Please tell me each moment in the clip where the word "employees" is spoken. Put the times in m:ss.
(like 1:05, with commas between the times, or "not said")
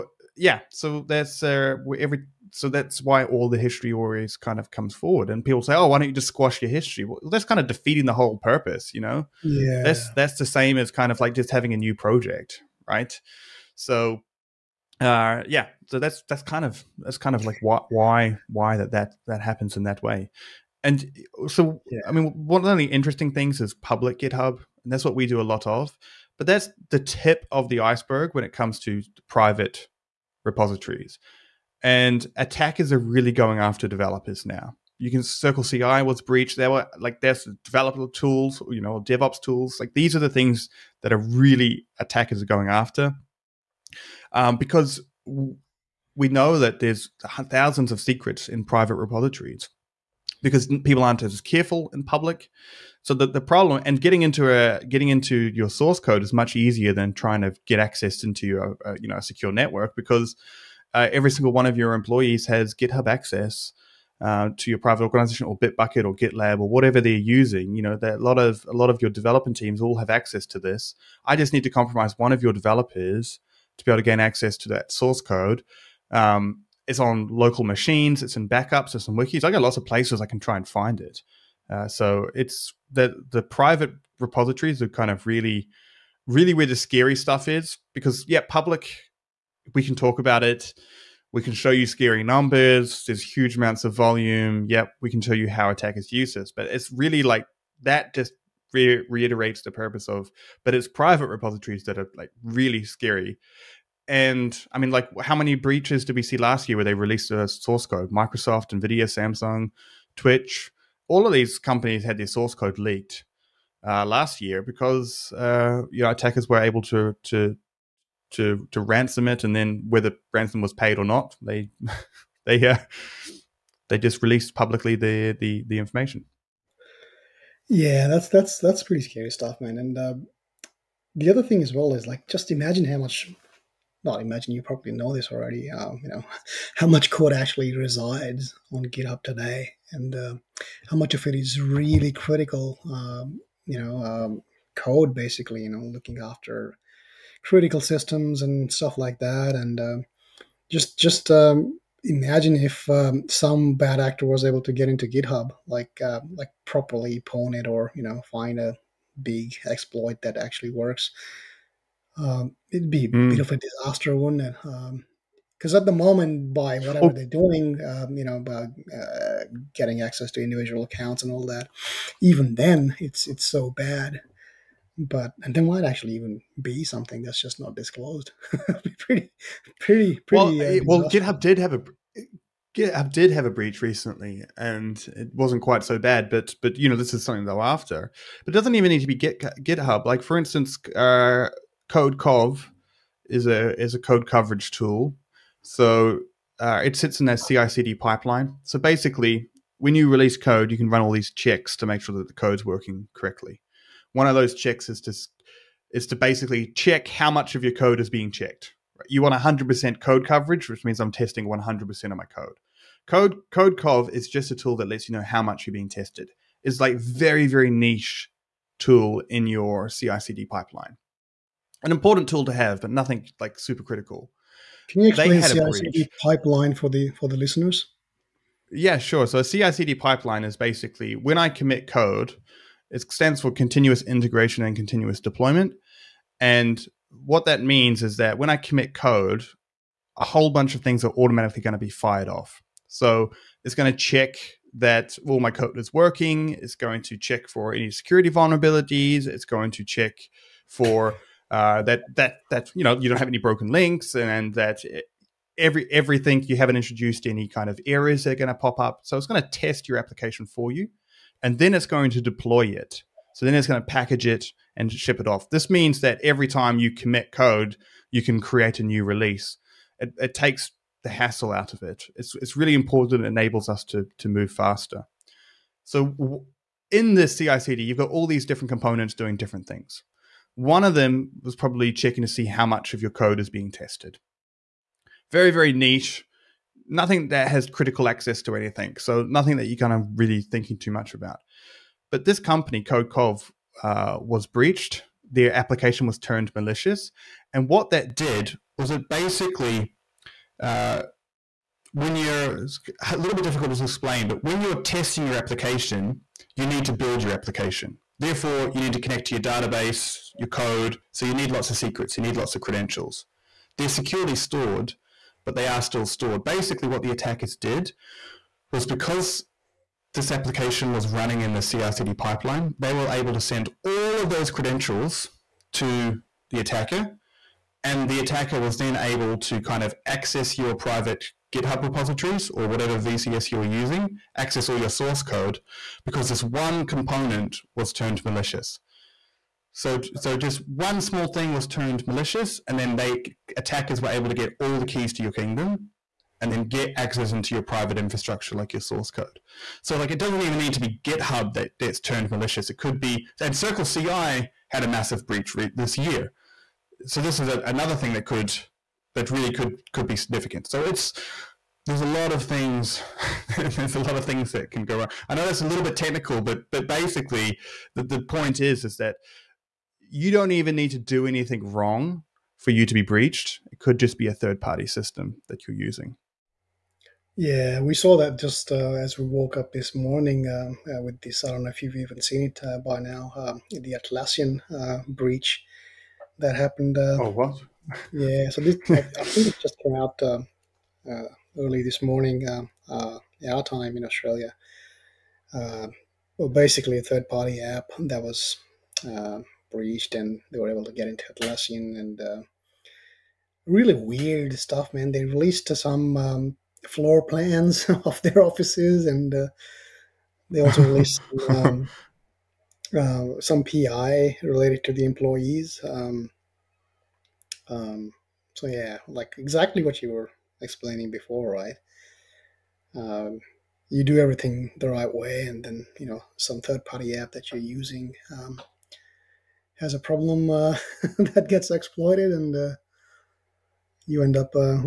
1:01, 6:55.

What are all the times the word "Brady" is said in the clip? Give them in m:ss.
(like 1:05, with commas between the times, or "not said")
not said.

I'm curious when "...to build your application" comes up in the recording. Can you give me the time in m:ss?
5:06.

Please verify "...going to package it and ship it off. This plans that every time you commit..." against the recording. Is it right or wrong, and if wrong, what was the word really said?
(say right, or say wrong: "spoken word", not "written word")
wrong: "means", not "plans".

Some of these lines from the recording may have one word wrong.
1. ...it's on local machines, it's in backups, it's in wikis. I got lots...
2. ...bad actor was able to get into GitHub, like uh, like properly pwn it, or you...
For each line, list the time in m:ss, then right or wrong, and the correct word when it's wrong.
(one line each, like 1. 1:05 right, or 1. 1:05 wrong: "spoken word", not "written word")
1. 1:16 right
2. 2:33 right.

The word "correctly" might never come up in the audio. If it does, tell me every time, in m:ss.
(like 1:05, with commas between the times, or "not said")
3:23.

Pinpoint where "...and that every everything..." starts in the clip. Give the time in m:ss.
4:14.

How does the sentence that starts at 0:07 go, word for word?
Well, that's kind of defeating the whole purpose, you know.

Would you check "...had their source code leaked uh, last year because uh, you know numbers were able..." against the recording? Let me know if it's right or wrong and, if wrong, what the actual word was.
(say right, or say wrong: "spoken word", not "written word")
wrong: "attackers", not "numbers".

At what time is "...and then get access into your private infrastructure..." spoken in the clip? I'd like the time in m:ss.
5:46.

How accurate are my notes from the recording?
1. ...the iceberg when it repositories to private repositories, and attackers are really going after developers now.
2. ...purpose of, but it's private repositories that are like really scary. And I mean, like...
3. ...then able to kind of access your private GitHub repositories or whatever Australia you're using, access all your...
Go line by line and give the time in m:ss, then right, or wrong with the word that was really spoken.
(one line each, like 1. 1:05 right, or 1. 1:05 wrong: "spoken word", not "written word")
1. 0:27 wrong: "comes", not "repositories"
2. 1:39 right
3. 5:28 wrong: "VCS", not "Australia".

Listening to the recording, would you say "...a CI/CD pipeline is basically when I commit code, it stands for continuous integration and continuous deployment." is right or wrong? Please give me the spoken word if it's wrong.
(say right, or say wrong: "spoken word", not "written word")
right.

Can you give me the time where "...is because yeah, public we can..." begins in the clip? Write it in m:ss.
1:27.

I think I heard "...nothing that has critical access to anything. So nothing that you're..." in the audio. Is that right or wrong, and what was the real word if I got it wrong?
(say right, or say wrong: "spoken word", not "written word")
right.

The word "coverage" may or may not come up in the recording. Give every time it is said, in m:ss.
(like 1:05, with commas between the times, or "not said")
3:14, 3:30.